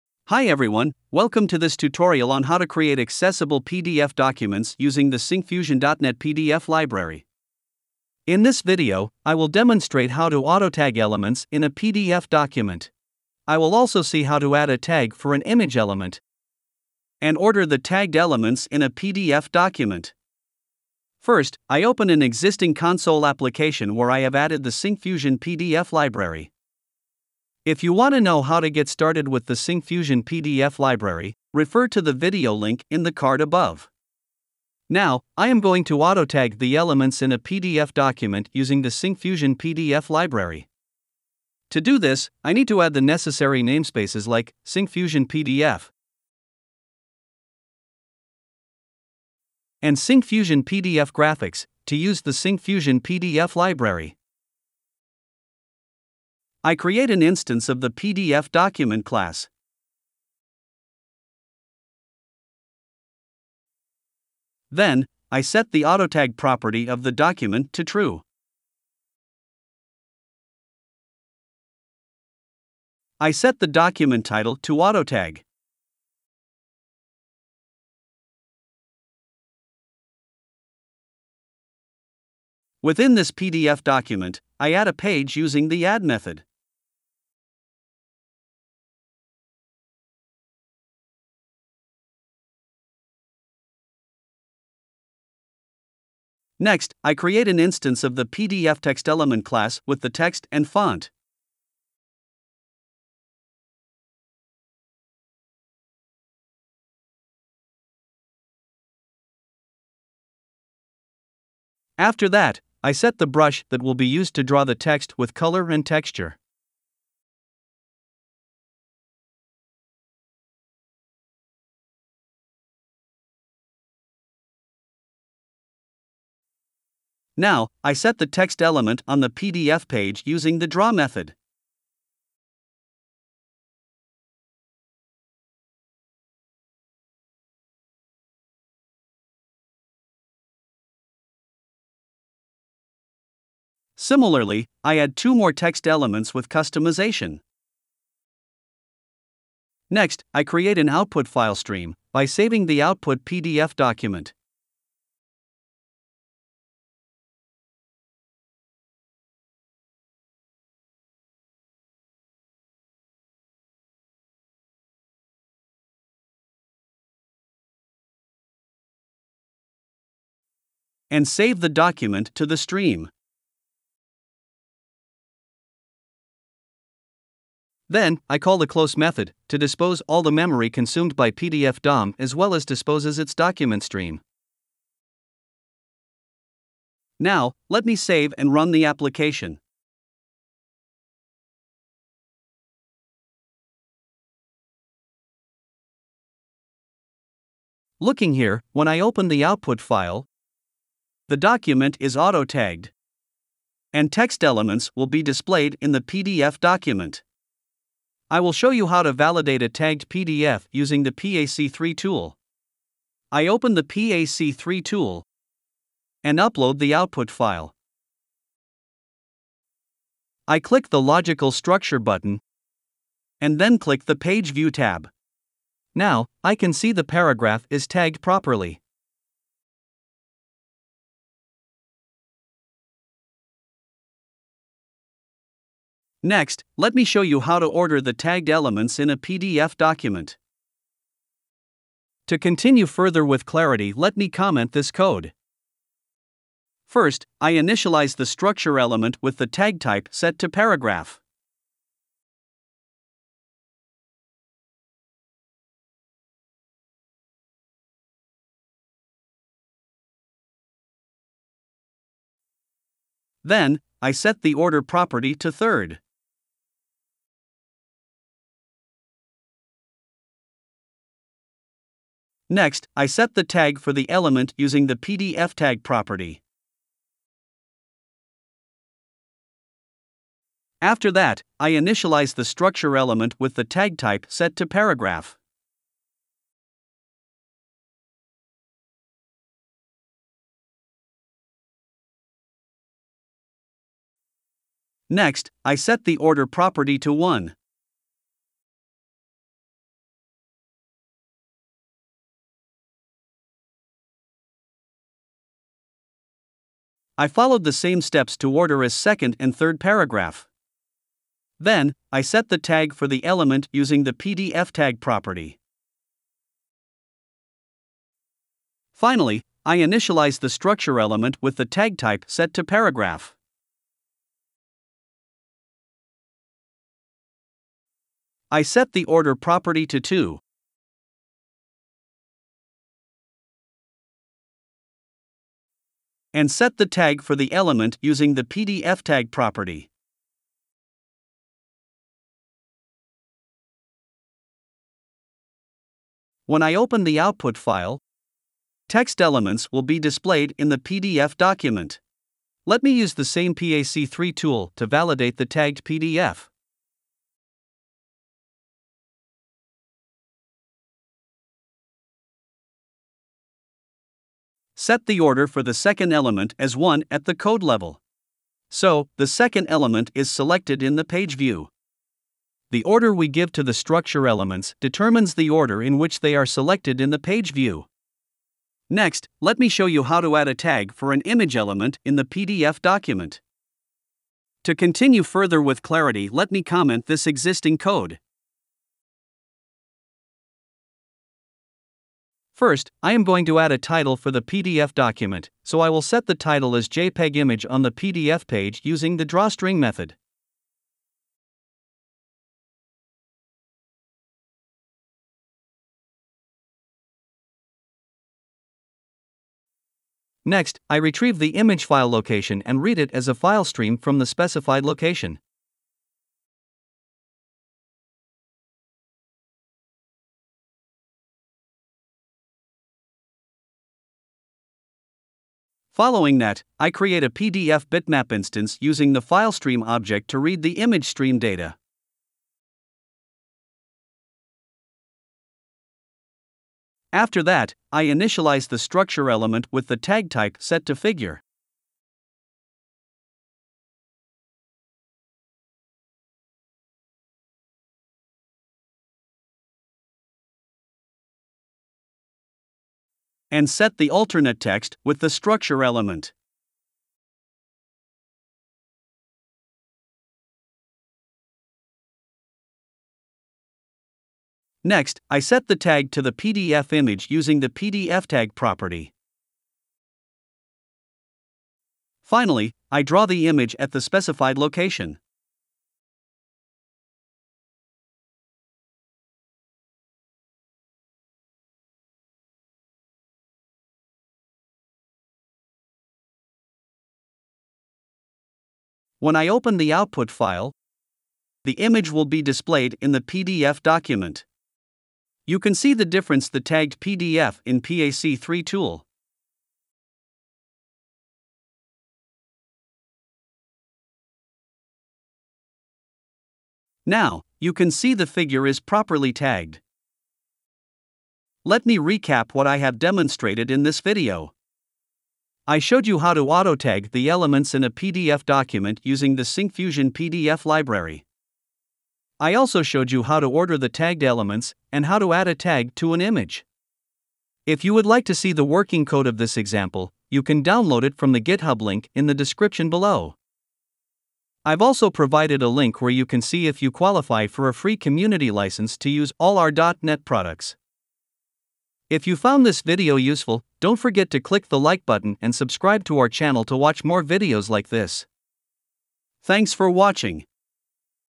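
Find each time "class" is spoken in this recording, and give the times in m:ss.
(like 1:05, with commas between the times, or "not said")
0:59, 1:39.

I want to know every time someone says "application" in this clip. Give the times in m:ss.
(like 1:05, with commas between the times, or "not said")
0:23, 3:08.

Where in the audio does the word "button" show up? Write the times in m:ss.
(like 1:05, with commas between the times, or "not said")
3:41, 9:05.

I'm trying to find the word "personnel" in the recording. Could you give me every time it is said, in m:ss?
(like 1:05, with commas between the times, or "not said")
not said.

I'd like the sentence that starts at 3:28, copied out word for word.
I will show you how to validate a tagged PDF using the PAC3 tool.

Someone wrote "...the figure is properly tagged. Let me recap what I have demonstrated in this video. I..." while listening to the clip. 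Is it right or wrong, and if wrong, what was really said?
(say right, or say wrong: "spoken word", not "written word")
right.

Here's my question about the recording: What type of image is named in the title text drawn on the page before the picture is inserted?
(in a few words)
JPEG.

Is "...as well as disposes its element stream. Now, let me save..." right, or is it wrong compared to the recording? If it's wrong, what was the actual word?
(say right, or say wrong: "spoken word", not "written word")
wrong: "document", not "element".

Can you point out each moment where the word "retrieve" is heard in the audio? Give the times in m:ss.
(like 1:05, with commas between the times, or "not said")
6:50.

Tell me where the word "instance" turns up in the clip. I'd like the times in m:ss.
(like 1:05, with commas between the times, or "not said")
0:57, 1:37, 7:08.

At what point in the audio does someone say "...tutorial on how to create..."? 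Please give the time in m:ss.
0:01.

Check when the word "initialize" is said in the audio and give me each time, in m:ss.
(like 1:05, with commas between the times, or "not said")
4:07, 4:41, 5:19, 7:18.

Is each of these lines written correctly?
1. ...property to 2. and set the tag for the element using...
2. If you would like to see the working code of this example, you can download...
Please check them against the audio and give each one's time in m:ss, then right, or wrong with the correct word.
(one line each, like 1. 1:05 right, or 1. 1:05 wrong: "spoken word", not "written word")
1. 5:29 right
2. 8:47 right.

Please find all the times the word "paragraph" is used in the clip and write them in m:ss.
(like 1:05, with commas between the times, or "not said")
3:47, 4:10, 4:44, 5:09, 5:22.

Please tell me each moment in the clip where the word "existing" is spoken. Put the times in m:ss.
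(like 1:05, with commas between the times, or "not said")
0:22, 6:27.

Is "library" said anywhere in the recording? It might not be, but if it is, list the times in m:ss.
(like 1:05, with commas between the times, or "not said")
0:06, 0:25, 0:30, 0:40, 0:53, 8:40.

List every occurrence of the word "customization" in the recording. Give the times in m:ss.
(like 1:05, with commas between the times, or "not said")
2:26.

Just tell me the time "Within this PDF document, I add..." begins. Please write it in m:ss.
1:22.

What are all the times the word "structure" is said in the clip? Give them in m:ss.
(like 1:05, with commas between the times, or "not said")
3:41, 4:08, 4:42, 5:20, 6:13, 7:18, 7:35.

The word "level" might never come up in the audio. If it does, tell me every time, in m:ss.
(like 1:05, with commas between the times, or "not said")
6:07.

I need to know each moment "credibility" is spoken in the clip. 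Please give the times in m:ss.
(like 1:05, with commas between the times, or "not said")
not said.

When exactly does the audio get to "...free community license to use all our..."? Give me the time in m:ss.
8:57.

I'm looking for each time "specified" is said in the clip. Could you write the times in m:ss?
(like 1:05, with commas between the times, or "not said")
6:54, 7:54.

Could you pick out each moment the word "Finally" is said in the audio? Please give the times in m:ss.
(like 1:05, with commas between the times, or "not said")
5:18, 7:52.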